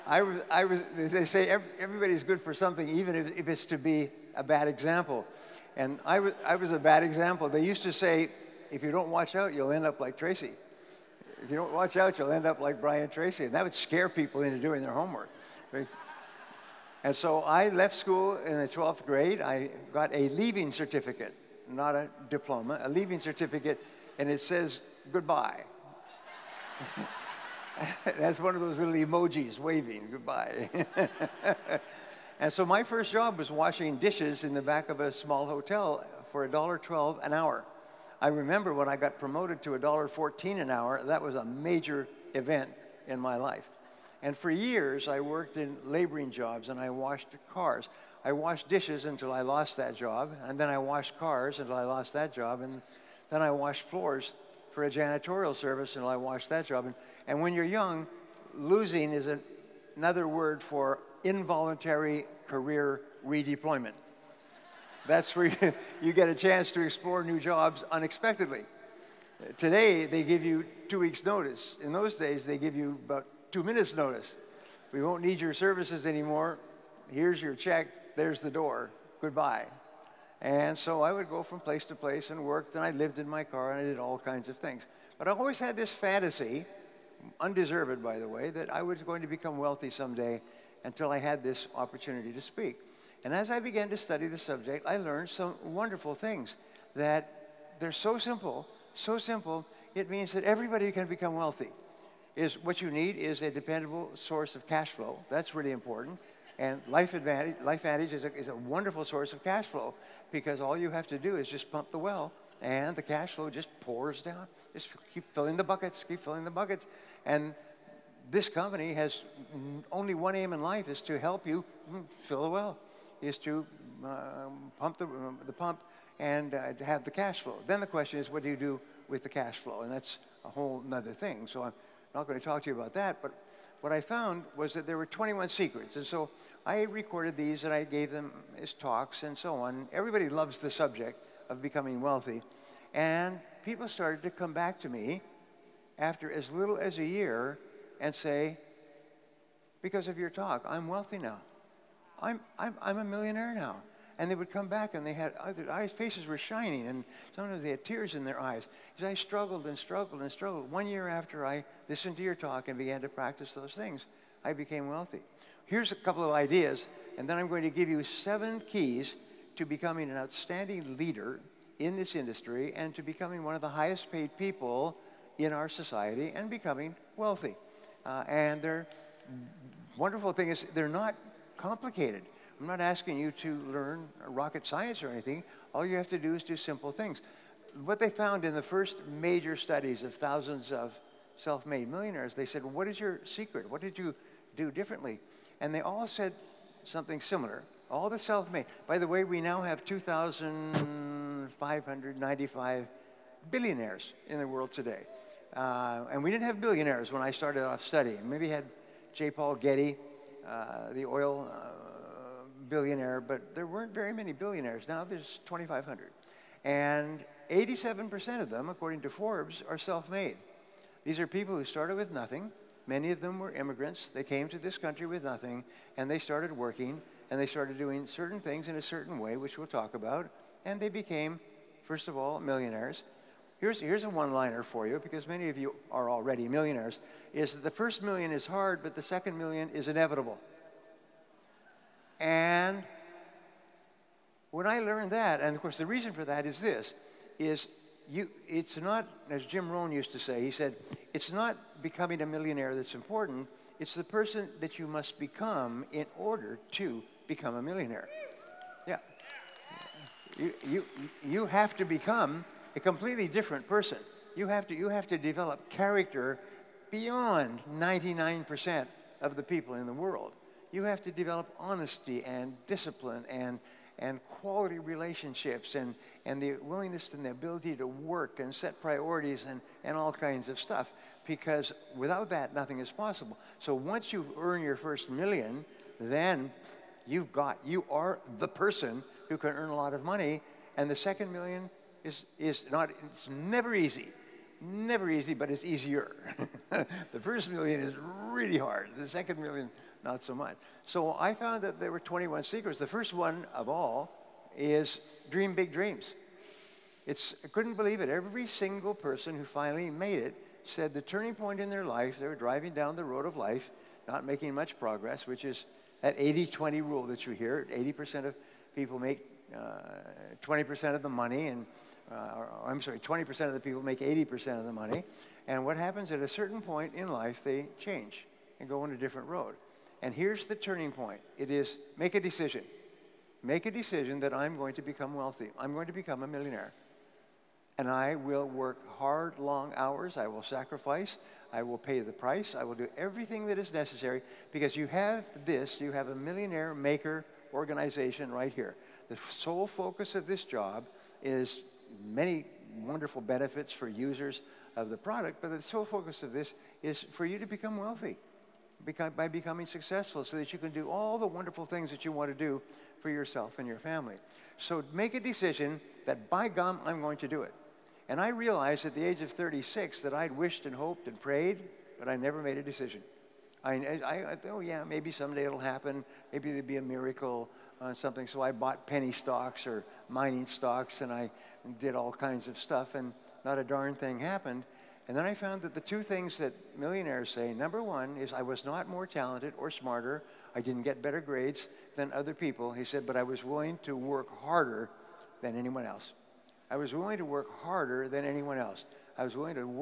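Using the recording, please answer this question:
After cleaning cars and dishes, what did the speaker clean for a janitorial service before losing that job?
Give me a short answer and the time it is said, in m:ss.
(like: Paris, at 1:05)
floors, at 0:53.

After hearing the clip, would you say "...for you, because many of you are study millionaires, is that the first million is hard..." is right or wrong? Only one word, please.
wrong.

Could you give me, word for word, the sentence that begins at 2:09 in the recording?
And that's a whole other thing.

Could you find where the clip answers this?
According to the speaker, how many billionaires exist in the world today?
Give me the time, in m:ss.
3:19.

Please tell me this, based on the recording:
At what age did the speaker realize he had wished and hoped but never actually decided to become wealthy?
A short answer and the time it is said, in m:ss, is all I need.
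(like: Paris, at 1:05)
36, at 6:09.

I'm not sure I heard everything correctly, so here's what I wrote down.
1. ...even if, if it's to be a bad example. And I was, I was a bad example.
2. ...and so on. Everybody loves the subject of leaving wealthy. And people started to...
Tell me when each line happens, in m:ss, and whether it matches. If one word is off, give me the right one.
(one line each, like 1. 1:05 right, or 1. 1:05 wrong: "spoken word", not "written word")
1. 0:02 right
2. 2:19 wrong: "becoming", not "leaving".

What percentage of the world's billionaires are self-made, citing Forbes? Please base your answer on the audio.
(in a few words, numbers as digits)
87%.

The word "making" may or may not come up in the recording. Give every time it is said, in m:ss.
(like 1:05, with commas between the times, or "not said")
5:14.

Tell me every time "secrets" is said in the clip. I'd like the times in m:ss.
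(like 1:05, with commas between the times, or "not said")
2:15, 3:13, 5:02.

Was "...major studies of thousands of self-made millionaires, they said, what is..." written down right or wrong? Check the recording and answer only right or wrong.
right.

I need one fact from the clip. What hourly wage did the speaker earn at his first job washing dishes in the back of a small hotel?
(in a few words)
$1.12.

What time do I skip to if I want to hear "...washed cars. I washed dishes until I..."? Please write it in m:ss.
0:46.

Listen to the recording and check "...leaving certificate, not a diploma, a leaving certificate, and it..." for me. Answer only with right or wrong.
right.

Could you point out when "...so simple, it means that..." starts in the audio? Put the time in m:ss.
1:38.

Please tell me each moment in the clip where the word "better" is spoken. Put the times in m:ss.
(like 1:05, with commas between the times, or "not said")
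6:31.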